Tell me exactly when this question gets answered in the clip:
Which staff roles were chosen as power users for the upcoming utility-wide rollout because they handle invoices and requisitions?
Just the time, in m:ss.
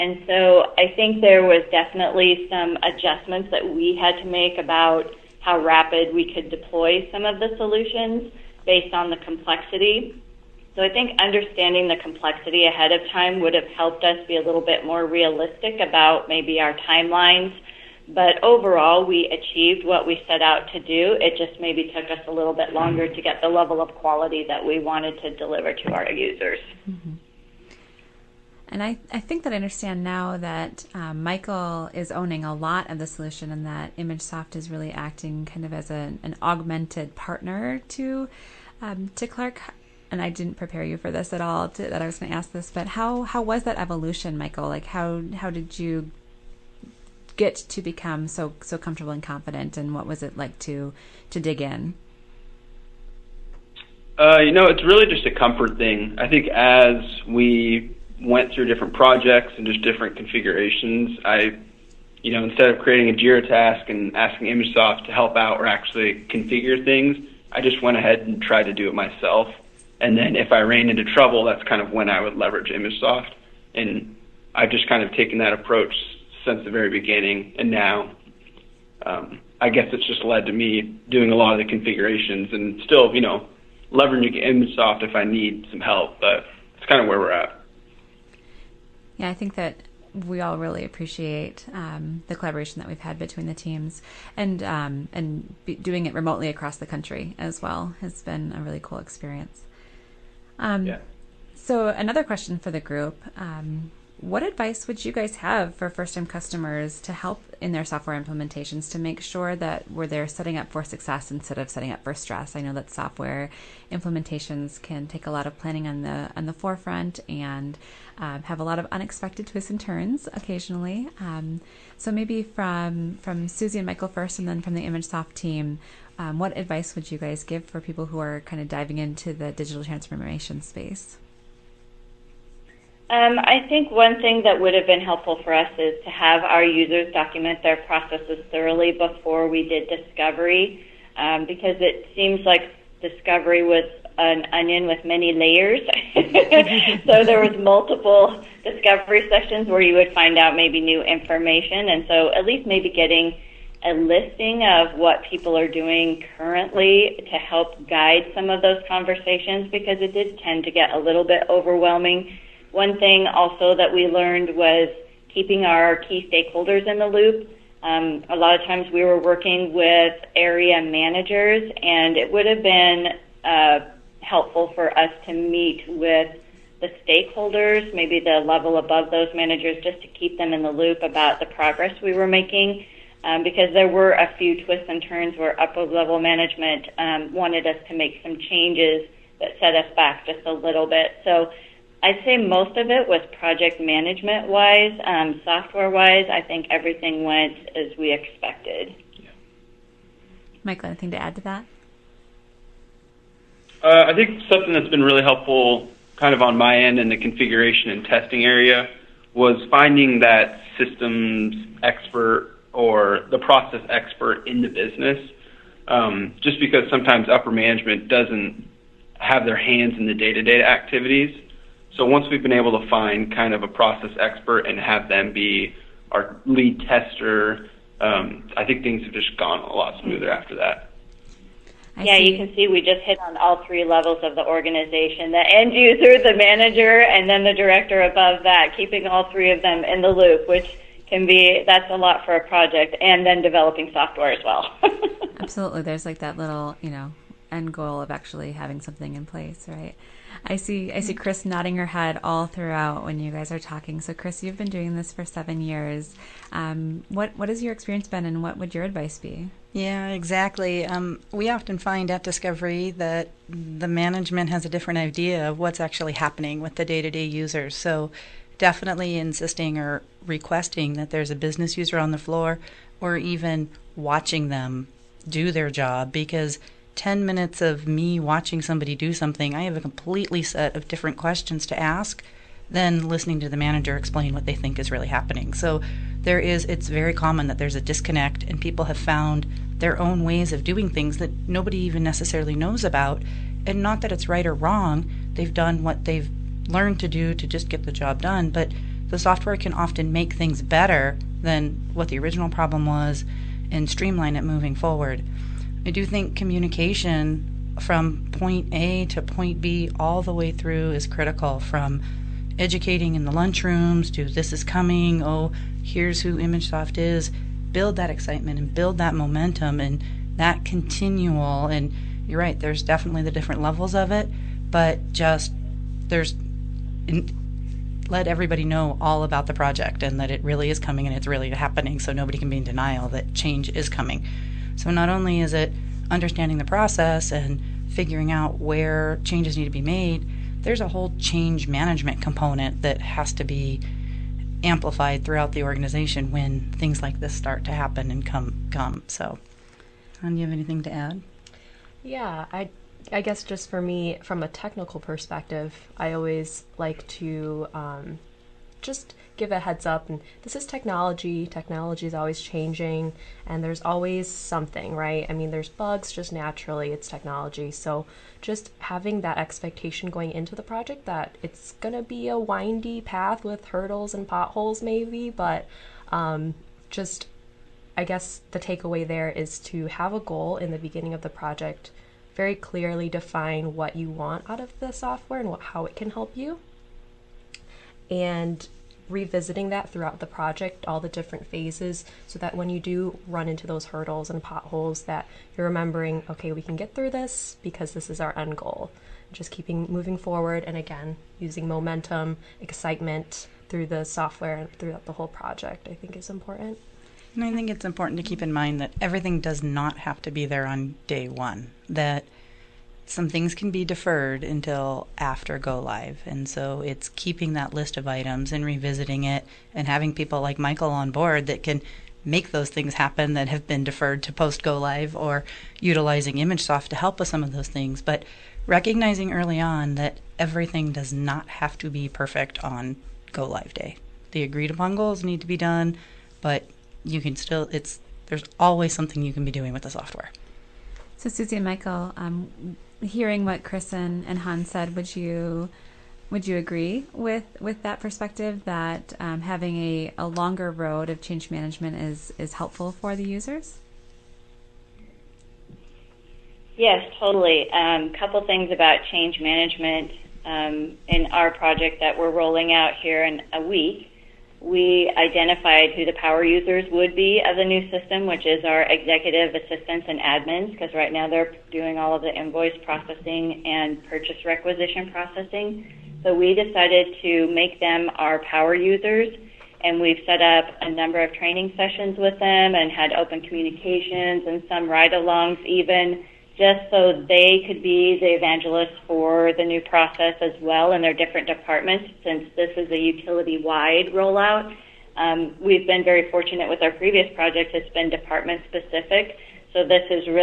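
7:48.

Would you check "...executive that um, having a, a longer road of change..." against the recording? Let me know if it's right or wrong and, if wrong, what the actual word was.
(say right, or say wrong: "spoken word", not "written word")
wrong: "perspective", not "executive".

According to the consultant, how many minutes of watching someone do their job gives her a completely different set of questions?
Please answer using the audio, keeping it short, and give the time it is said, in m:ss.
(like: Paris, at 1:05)
10, at 4:36.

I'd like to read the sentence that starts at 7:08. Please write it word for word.
But recognizing early on that everything does not have to be perfect on go live day.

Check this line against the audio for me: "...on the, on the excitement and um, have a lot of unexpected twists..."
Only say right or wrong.
wrong.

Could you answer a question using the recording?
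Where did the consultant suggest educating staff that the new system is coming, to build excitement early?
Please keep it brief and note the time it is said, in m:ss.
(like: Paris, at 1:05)
Lunchrooms, at 5:13.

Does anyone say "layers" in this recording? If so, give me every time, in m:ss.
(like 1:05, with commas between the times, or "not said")
2:25.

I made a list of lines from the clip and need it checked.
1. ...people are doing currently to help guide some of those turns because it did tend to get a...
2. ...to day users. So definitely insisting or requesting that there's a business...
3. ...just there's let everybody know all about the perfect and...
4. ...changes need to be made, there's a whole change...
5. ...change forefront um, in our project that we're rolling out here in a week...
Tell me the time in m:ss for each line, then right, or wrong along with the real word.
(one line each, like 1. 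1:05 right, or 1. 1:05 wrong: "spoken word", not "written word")
1. 2:35 wrong: "conversations", not "turns"
2. 4:27 right
3. 5:25 wrong: "project", not "perfect"
4. 5:39 right
5. 7:39 wrong: "management", not "forefront".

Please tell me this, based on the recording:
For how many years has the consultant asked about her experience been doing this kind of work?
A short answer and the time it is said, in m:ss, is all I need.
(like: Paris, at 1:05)
7, at 4:15.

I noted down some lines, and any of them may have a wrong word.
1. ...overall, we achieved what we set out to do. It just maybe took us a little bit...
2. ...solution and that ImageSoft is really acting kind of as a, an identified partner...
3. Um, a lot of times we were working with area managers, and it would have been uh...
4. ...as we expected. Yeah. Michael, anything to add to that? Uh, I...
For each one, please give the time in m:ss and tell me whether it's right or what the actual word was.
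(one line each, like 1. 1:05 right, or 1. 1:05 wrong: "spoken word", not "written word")
1. 0:18 right
2. 0:33 wrong: "augmented", not "identified"
3. 2:47 right
4. 3:17 right.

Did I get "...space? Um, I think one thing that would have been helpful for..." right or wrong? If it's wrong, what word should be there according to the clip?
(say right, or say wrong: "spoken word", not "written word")
right.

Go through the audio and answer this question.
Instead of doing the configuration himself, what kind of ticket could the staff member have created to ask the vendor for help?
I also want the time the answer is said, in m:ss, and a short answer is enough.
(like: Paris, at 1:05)
Jira task, at 1:03.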